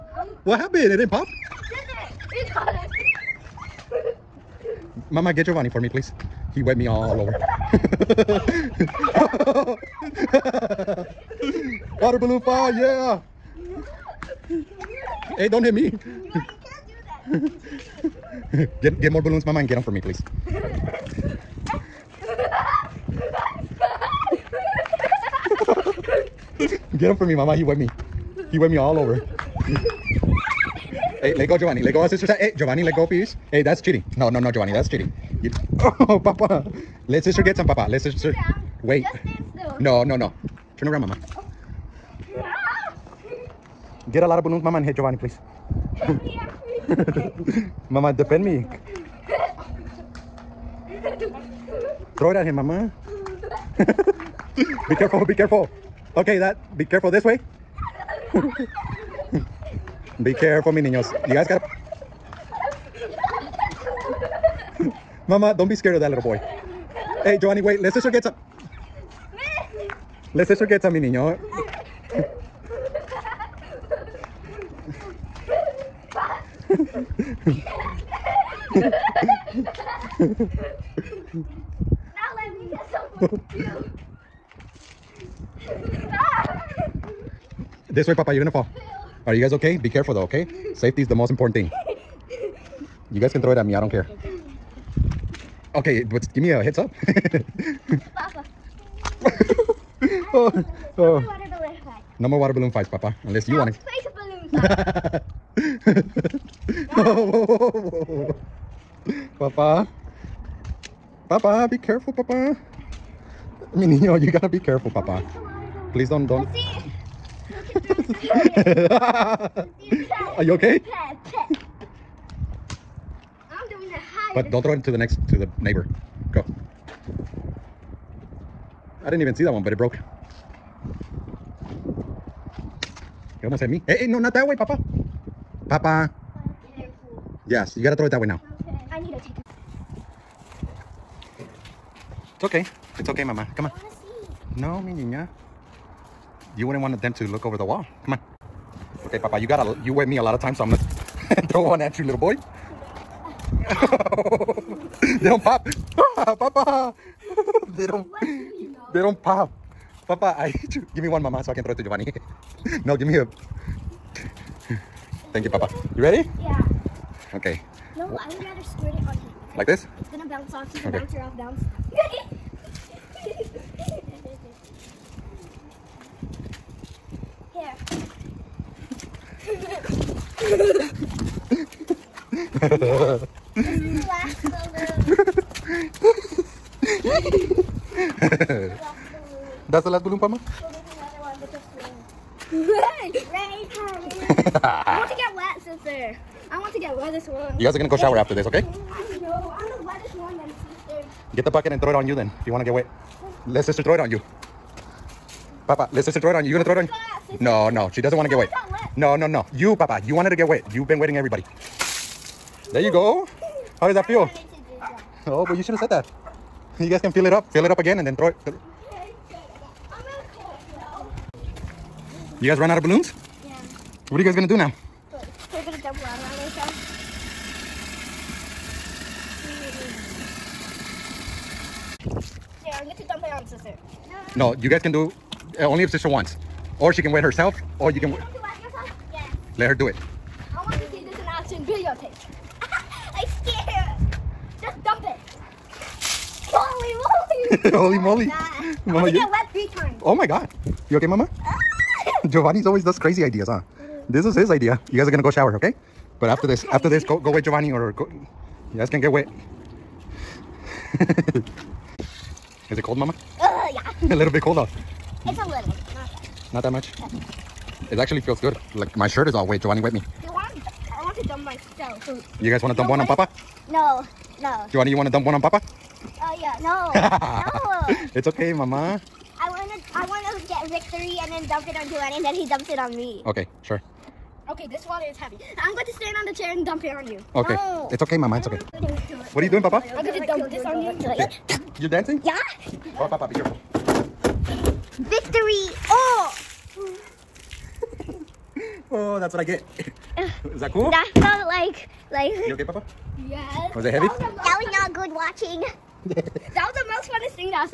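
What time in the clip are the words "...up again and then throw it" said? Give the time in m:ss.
3:37.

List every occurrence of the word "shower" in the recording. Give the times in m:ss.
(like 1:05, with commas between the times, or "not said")
3:17, 4:15.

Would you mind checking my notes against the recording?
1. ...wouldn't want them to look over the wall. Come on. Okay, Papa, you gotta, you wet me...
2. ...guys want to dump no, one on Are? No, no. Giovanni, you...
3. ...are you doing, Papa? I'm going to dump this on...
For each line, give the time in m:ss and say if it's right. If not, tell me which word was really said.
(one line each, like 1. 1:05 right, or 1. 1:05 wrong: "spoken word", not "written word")
1. 2:26 right
2. 4:32 wrong: "Papa", not "Are"
3. 4:49 right.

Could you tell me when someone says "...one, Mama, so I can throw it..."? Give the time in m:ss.
2:41.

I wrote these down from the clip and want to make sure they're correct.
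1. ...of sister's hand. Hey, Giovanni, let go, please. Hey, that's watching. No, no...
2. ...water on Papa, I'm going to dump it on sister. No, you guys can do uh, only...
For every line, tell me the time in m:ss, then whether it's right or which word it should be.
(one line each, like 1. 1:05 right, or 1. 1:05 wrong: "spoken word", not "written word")
1. 0:32 wrong: "cheating", not "watching"
2. 3:45 wrong: "Yeah", not "Papa".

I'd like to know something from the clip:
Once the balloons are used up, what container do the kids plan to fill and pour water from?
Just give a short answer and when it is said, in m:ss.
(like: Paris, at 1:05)
The bucket, at 3:21.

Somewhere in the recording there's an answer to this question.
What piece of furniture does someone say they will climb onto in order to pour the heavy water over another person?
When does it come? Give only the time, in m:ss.
4:46.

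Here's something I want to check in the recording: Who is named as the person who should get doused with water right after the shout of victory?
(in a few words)
Juan.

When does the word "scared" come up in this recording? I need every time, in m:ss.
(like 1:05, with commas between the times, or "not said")
1:05, 4:03.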